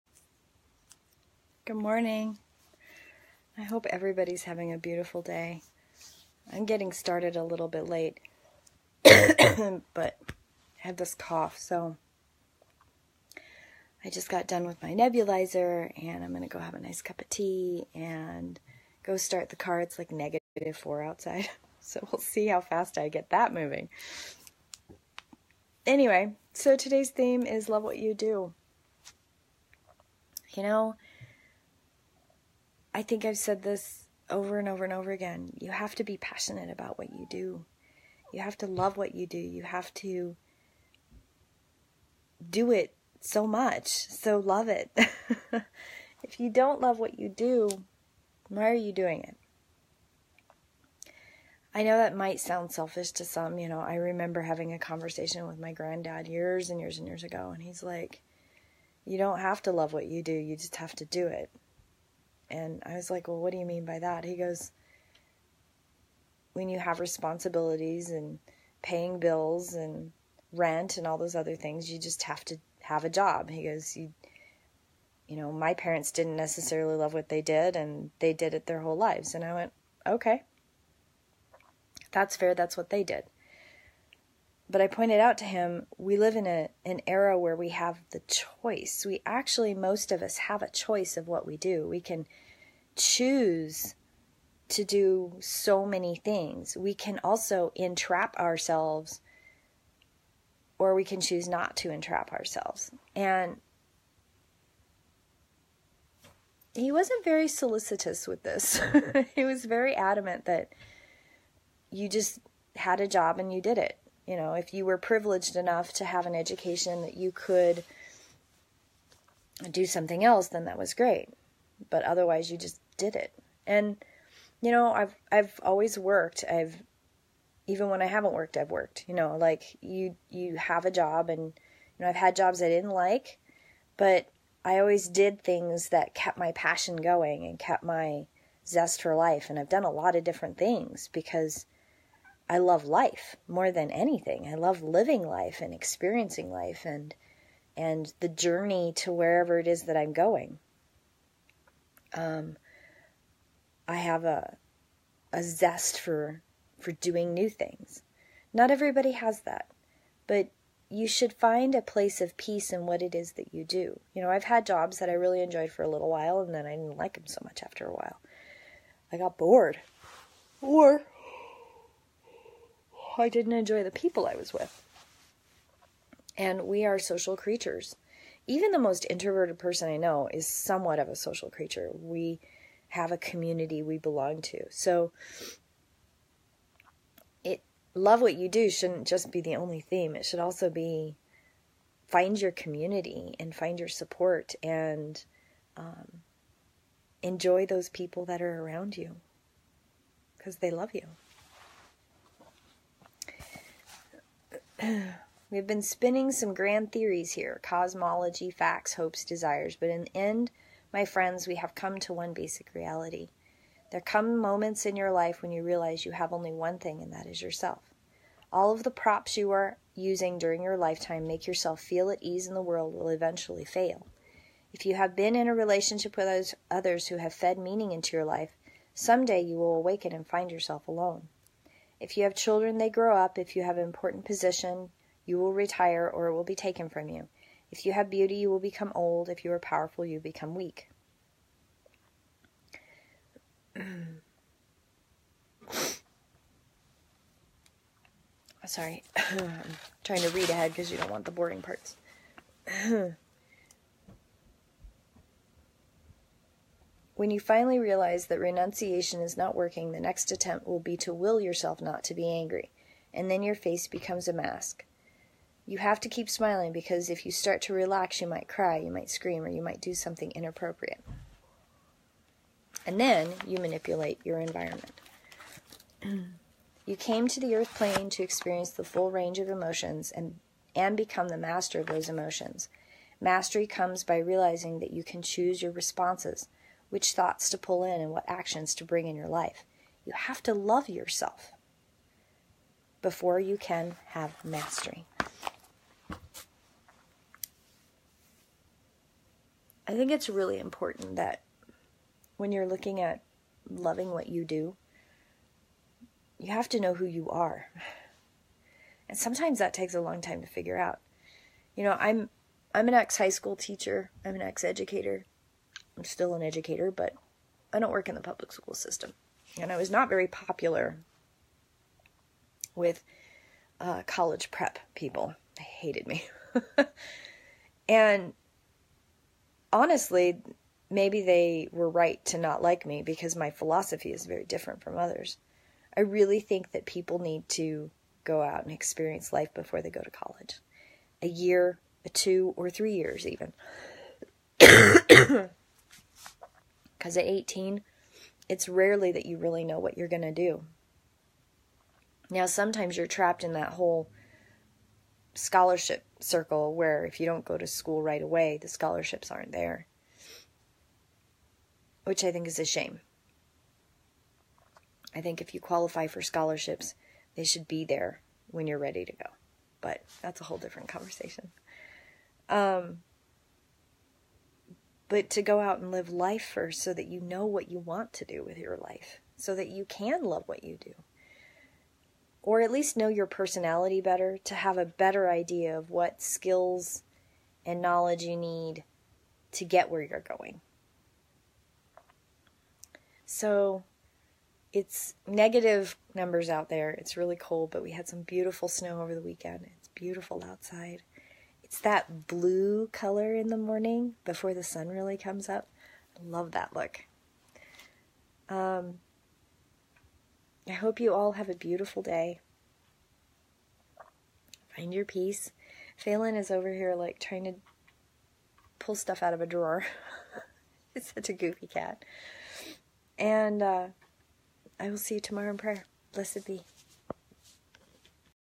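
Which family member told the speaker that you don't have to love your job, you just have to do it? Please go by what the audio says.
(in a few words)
Granddad.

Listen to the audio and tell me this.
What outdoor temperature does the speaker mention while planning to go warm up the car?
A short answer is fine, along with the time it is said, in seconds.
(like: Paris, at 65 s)
-4, at 20 s.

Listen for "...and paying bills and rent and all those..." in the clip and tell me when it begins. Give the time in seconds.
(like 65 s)
68 s.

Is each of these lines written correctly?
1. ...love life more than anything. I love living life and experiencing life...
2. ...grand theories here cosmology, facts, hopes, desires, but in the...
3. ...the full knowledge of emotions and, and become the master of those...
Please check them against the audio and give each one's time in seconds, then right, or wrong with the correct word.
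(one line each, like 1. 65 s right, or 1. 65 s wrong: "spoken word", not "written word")
1. 142 s right
2. 206 s right
3. 278 s wrong: "range", not "knowledge".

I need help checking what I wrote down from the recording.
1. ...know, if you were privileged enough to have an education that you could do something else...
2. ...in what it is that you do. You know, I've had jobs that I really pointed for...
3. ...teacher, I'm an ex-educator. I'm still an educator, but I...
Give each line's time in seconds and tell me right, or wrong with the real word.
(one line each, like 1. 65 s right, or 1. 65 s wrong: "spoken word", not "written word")
1. 114 s right
2. 162 s wrong: "enjoyed", not "pointed"
3. 313 s right.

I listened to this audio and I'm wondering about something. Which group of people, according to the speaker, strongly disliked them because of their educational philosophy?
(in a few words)
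College prep people.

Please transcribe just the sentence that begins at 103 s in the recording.
And he wasn't very solicitous with this.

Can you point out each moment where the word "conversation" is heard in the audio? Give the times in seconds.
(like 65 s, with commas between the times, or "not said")
54 s, 370 s.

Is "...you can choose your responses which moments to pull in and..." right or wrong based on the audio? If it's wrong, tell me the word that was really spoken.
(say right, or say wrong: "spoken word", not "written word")
wrong: "thoughts", not "moments".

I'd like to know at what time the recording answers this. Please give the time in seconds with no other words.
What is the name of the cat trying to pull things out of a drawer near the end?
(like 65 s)
415 s.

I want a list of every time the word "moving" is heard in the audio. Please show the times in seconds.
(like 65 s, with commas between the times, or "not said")
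23 s.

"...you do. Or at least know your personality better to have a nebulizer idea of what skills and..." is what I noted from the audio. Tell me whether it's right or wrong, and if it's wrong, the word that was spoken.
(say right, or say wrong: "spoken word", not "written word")
wrong: "better", not "nebulizer".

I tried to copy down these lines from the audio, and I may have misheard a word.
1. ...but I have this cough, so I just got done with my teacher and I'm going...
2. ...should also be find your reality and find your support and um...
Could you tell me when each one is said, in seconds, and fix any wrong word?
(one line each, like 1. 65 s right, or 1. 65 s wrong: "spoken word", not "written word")
1. 9 s wrong: "nebulizer", not "teacher"
2. 190 s wrong: "community", not "reality".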